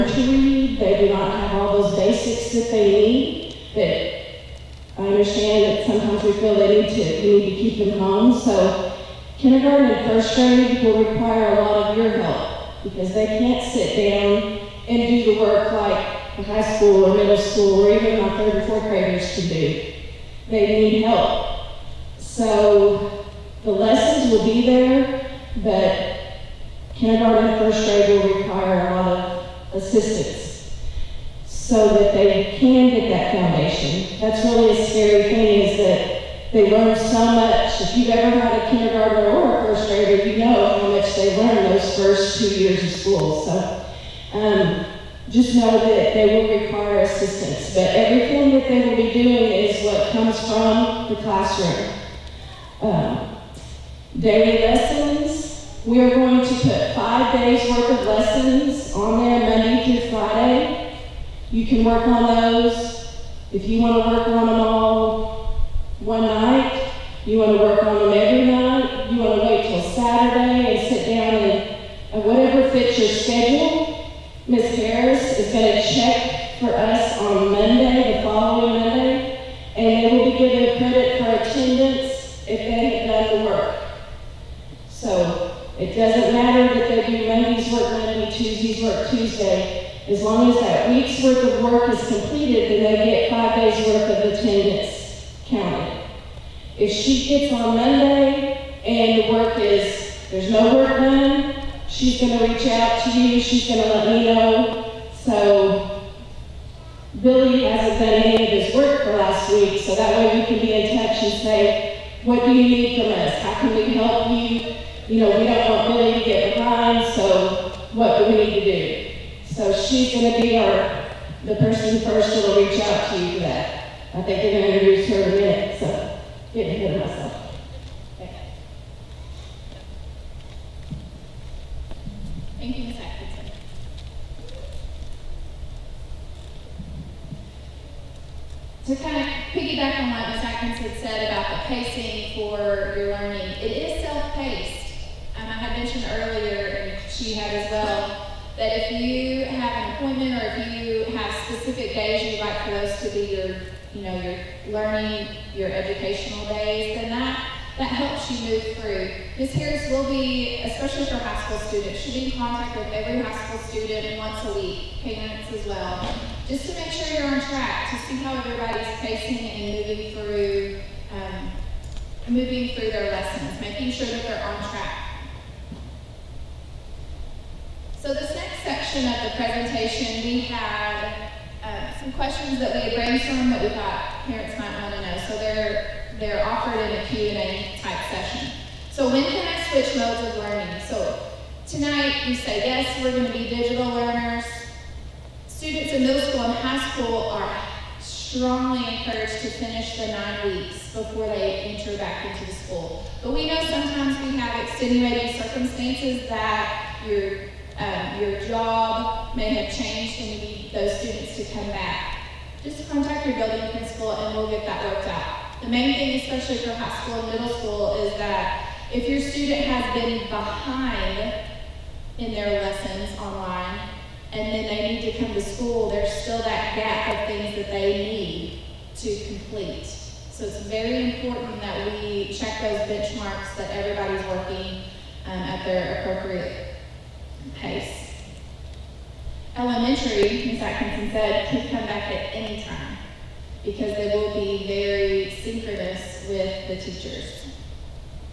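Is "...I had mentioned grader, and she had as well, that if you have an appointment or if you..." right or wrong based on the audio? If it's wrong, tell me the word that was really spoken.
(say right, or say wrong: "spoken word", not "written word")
wrong: "earlier", not "grader".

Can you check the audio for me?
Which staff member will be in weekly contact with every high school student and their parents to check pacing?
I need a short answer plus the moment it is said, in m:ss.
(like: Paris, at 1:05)
Ms. Harris, at 2:39.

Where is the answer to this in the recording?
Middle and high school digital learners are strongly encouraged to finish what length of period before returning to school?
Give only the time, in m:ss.
3:20.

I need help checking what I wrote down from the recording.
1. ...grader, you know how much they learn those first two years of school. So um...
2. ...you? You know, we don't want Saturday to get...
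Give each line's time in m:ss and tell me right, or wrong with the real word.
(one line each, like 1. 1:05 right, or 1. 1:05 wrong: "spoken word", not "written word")
1. 0:39 right
2. 1:54 wrong: "Billy", not "Saturday".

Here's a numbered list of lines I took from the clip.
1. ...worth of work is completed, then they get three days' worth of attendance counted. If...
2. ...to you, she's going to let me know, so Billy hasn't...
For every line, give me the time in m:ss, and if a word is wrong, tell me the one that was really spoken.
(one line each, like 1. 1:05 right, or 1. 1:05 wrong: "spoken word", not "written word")
1. 1:31 wrong: "five", not "three"
2. 1:43 right.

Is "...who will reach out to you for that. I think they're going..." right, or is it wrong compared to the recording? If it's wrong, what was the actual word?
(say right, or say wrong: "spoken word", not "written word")
right.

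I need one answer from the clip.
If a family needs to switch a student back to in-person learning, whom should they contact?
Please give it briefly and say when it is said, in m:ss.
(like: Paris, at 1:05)
building principal, at 3:33.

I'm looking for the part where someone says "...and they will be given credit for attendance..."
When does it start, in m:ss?
1:19.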